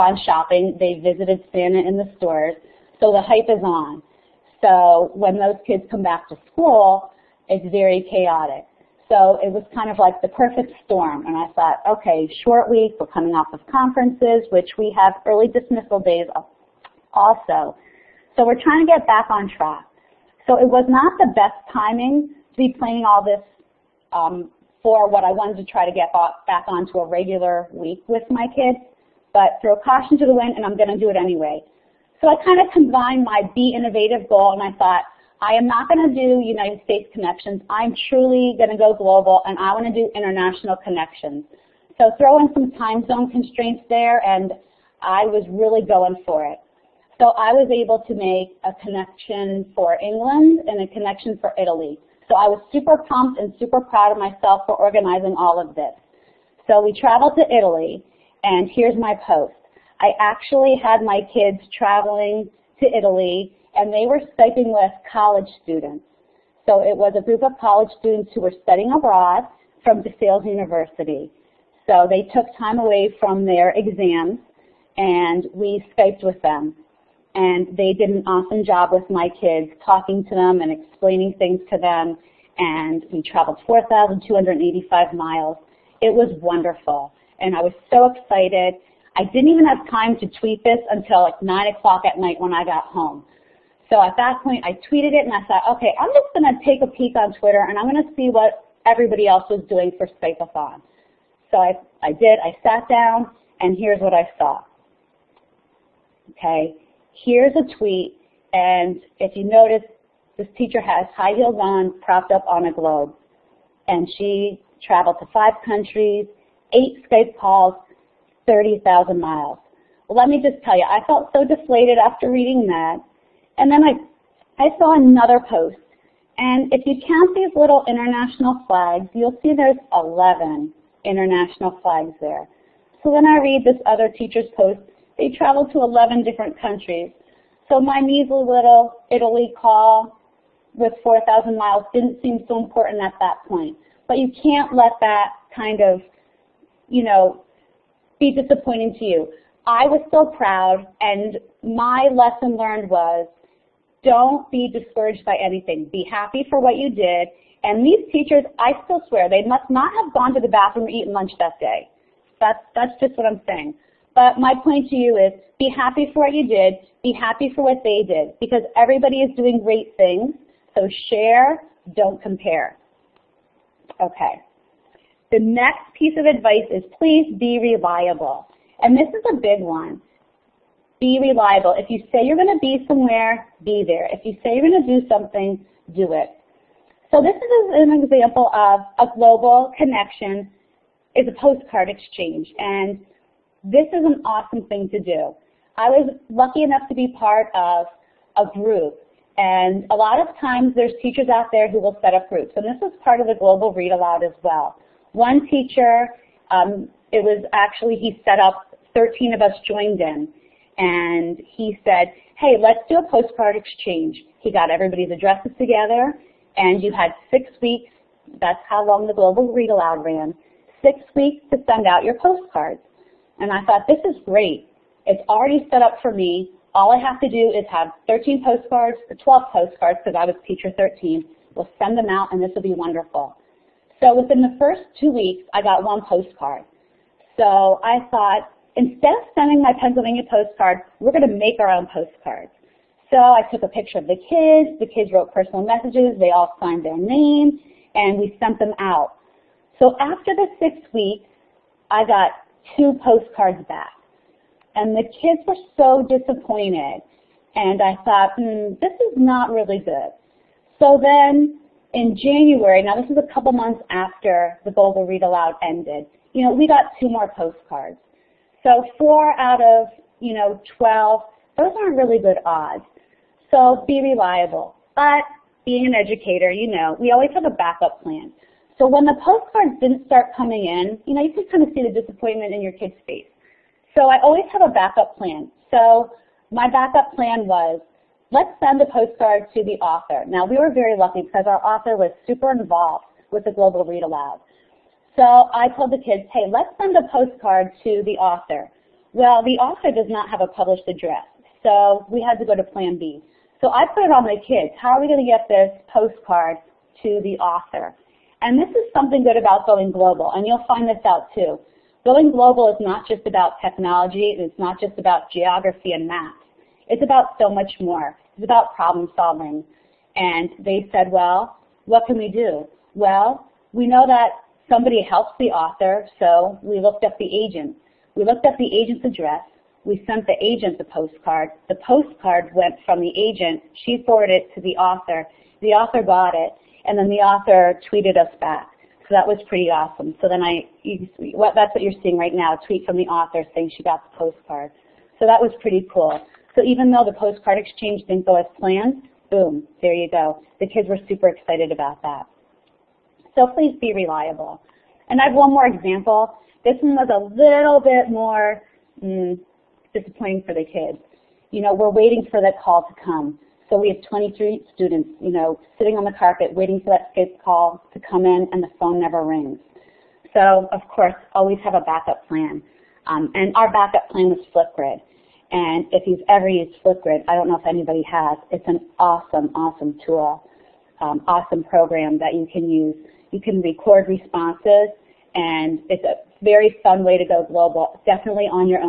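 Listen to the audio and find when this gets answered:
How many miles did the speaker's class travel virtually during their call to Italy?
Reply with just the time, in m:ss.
1:23.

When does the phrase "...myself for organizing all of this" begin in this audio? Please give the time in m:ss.
0:54.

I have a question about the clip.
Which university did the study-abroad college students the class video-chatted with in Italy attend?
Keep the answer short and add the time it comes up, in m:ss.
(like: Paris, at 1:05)
DeSales University, at 1:10.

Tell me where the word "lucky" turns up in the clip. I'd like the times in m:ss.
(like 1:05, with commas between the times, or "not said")
3:16, 4:50.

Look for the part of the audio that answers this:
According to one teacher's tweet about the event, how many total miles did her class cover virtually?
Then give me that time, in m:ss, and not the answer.
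1:58.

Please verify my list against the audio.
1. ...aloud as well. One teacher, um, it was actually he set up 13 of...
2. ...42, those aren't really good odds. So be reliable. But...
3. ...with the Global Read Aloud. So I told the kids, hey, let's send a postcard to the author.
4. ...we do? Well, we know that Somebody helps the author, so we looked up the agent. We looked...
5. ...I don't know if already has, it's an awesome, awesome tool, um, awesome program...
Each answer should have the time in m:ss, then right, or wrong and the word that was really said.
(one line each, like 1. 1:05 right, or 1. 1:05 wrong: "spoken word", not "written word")
1. 3:23 right
2. 4:30 wrong: "12", not "42"
3. 4:53 right
4. 5:22 right
5. 6:17 wrong: "anybody", not "already".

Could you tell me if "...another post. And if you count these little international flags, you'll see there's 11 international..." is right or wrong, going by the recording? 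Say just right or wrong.
right.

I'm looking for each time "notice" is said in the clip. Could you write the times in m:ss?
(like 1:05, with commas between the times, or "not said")
1:49.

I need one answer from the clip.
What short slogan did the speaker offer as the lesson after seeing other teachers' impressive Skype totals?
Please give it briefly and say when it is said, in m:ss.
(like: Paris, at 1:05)
Share, don't compare, at 2:51.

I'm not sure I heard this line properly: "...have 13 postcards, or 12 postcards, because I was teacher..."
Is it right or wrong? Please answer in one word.
right.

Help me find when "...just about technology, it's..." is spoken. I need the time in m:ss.
5:13.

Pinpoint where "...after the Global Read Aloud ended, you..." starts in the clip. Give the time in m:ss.
4:23.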